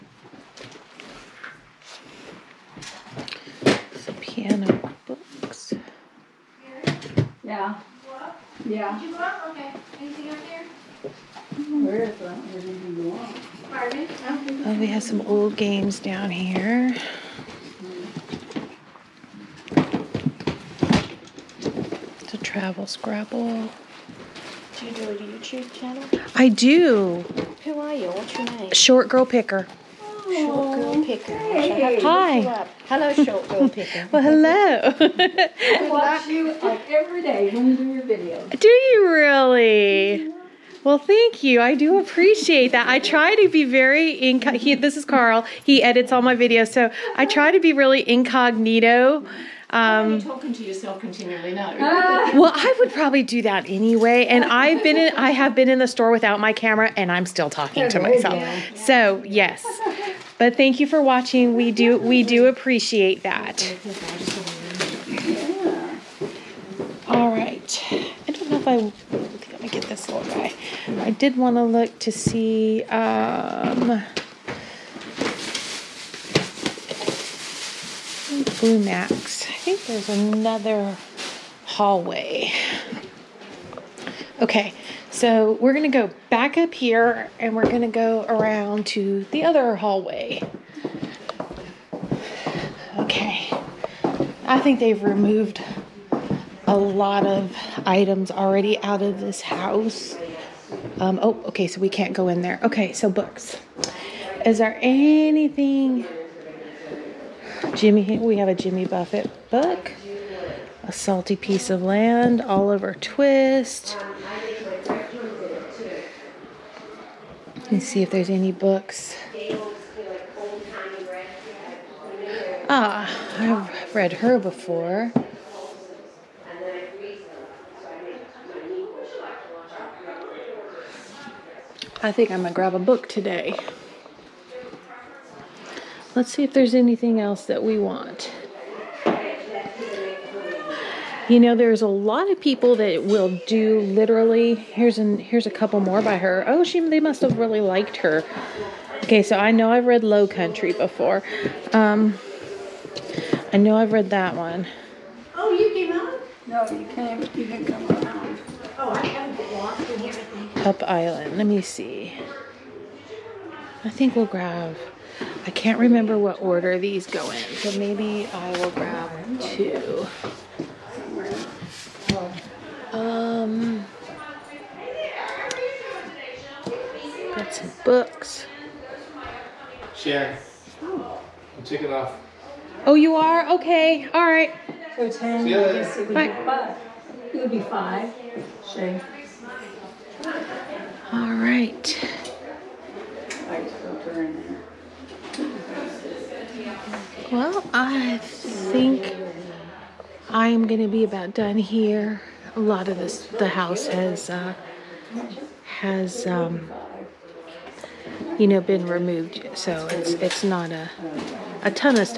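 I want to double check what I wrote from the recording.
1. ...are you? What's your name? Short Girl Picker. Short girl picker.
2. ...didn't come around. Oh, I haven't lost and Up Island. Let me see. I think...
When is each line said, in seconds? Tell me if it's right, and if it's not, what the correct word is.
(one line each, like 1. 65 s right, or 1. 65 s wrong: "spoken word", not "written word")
1. 27 s right
2. 157 s right.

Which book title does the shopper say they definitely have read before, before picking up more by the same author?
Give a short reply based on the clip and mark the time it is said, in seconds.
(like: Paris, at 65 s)
Low Country, at 150 s.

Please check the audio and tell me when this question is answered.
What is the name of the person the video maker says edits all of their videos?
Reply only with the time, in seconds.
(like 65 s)
45 s.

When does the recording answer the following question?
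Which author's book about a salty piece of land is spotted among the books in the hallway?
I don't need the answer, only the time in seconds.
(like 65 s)
108 s.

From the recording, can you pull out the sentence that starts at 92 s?
Okay, I think they've removed a lot of items already out of this house.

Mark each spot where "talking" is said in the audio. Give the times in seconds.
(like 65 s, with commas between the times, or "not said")
50 s, 57 s.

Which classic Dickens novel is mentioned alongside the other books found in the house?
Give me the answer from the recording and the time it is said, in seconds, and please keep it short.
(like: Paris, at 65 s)
Oliver Twist, at 112 s.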